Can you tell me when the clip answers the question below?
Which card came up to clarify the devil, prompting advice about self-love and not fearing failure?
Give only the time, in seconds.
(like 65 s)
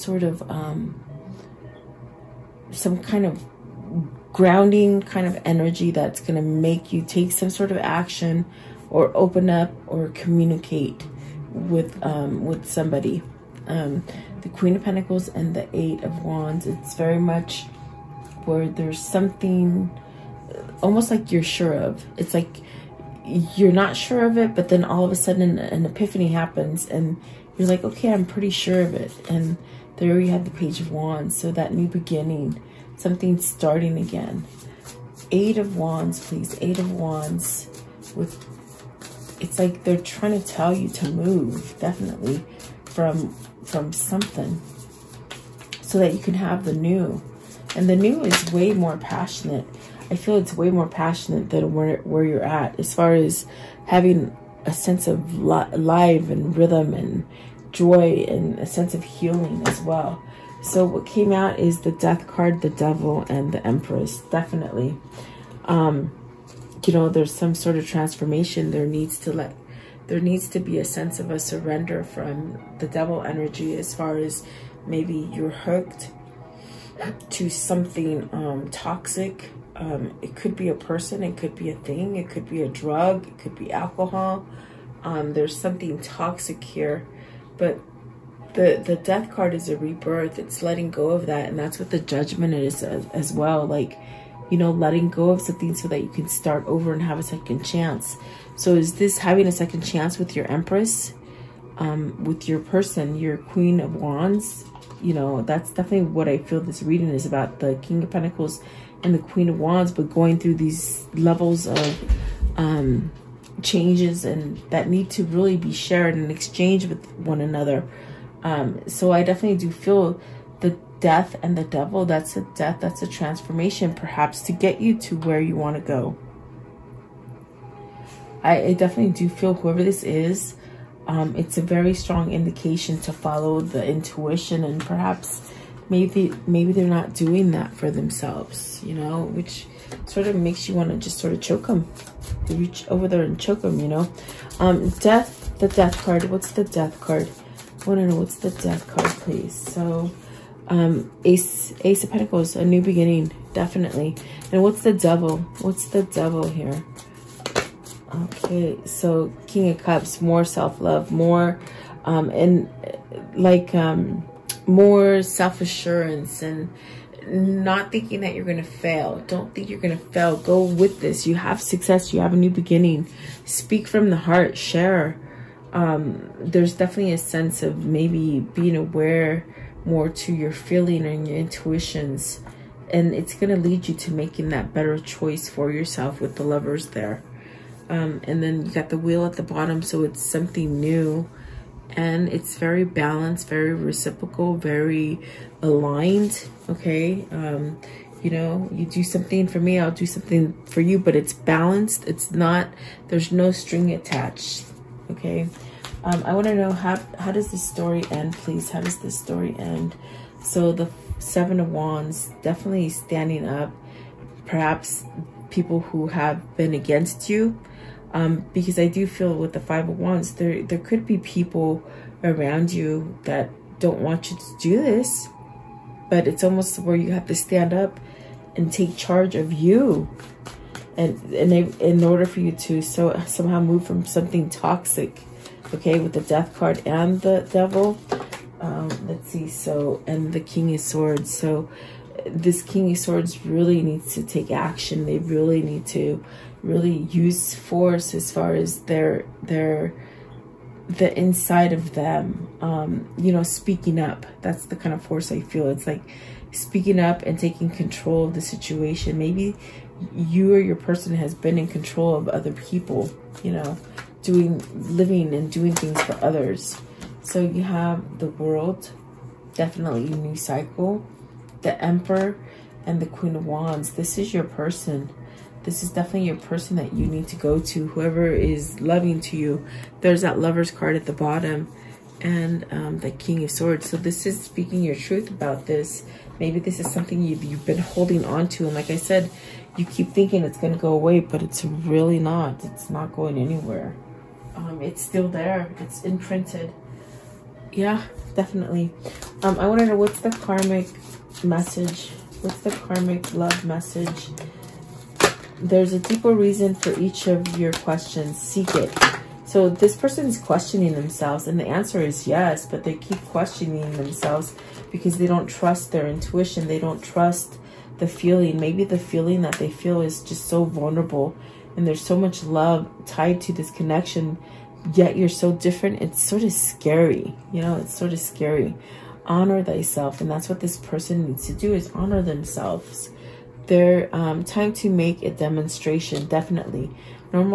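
159 s.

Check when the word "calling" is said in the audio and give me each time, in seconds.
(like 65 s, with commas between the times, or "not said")
not said.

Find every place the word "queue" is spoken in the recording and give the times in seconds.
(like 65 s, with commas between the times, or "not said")
not said.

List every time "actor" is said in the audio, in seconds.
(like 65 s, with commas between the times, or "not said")
not said.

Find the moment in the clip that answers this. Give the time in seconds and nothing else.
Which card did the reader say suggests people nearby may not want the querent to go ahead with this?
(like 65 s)
219 s.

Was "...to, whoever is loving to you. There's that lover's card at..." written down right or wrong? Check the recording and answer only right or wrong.
right.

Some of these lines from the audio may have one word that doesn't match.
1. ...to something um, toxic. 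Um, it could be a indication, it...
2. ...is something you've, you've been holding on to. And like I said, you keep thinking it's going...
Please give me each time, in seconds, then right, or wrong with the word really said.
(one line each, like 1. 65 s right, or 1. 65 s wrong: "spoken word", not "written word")
1. 77 s wrong: "person", not "indication"
2. 286 s right.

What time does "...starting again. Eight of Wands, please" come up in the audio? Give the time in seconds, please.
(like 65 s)
33 s.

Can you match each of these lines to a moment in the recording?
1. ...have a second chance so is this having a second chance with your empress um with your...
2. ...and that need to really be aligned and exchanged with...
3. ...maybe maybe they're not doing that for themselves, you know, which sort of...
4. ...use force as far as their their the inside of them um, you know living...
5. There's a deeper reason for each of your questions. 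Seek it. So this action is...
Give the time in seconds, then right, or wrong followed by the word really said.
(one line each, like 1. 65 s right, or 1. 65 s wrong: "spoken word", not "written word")
1. 97 s right
2. 114 s wrong: "shared", not "aligned"
3. 135 s right
4. 247 s wrong: "speaking", not "living"
5. 305 s wrong: "person", not "action".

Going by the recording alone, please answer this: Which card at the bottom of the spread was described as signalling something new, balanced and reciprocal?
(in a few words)
The Wheel.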